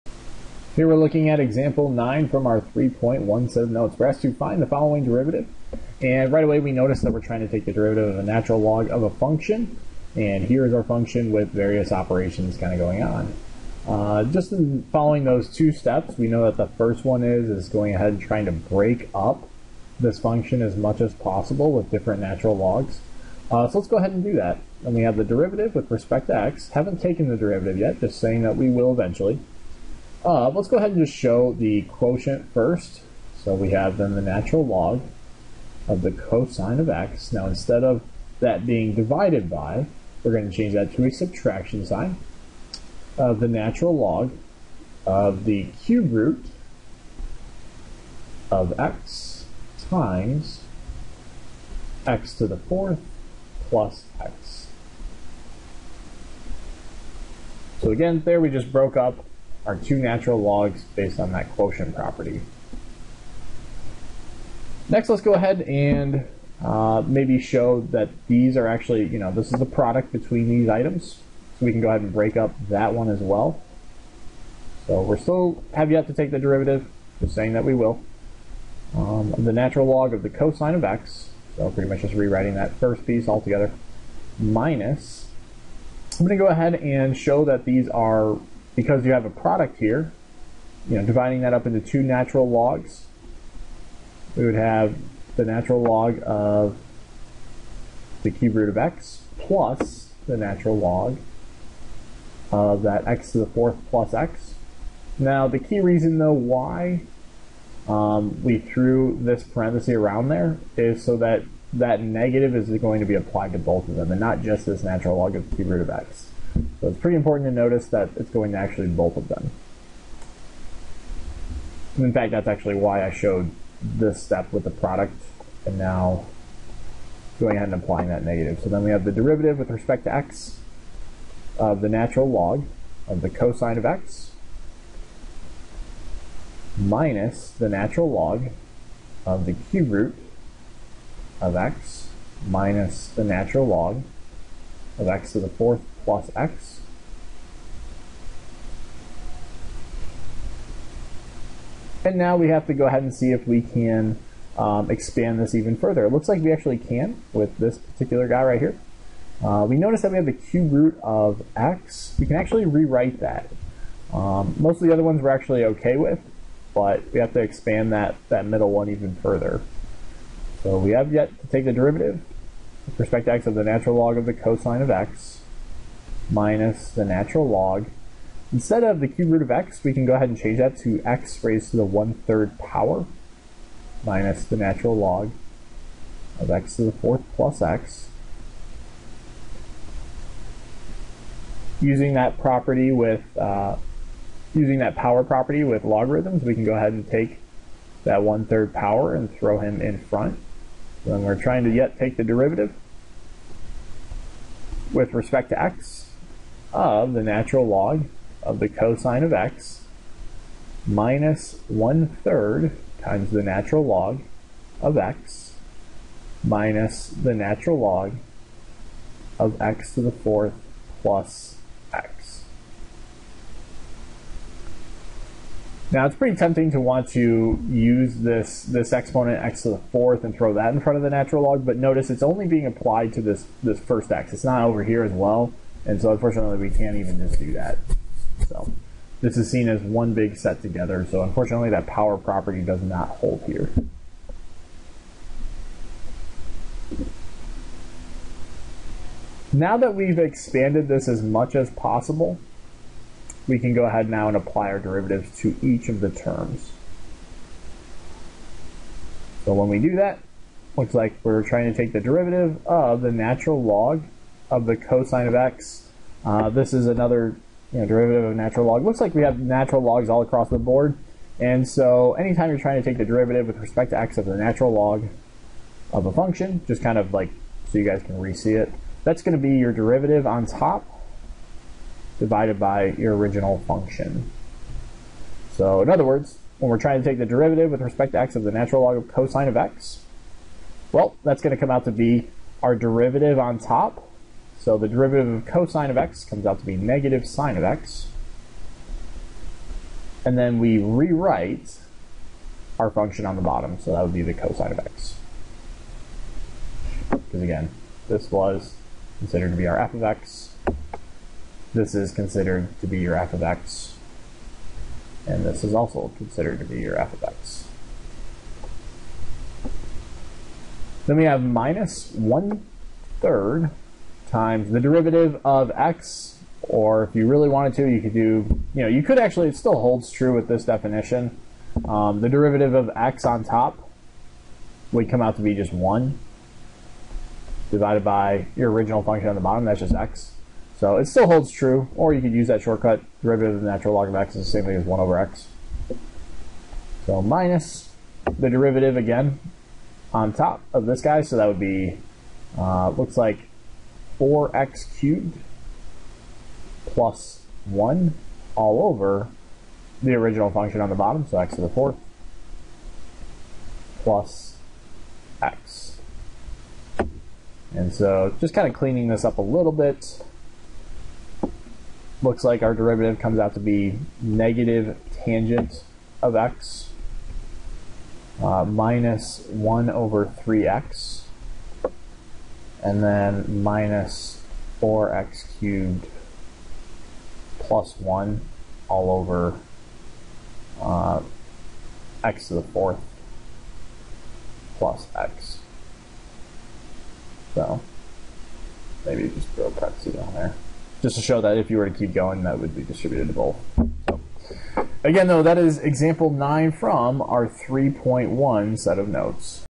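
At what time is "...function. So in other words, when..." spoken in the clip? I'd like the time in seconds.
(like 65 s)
283 s.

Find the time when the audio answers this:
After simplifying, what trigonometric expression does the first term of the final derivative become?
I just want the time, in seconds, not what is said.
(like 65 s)
374 s.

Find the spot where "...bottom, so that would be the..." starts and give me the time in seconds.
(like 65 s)
303 s.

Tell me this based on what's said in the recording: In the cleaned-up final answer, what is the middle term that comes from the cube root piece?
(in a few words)
1 over 3x.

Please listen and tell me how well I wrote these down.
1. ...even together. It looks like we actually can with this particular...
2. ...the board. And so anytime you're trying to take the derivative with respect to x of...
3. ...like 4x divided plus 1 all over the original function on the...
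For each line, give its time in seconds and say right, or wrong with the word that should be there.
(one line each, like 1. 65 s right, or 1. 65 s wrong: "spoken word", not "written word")
1. 155 s wrong: "further", not "together"
2. 270 s right
3. 353 s wrong: "cubed", not "divided".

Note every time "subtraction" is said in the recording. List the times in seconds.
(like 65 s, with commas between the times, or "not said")
41 s.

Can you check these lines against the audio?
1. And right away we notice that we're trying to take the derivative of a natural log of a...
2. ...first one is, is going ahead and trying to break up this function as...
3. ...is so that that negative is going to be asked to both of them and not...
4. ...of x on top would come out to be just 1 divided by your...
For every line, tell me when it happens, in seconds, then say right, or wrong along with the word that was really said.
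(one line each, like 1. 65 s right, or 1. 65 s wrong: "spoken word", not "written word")
1. 6 s right
2. 16 s right
3. 110 s wrong: "applied", not "asked"
4. 332 s right.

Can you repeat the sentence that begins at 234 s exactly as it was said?
It's not over here as well, and so unfortunately we can't even just do that.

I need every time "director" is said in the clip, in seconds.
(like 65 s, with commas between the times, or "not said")
not said.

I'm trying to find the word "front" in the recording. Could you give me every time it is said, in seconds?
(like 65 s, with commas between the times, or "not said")
199 s, 230 s.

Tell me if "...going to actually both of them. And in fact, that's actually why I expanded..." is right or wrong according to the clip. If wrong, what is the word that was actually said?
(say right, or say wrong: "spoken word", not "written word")
wrong: "showed", not "expanded".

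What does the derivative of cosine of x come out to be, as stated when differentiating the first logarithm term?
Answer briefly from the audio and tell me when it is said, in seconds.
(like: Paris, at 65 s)
negative sine of x, at 296 s.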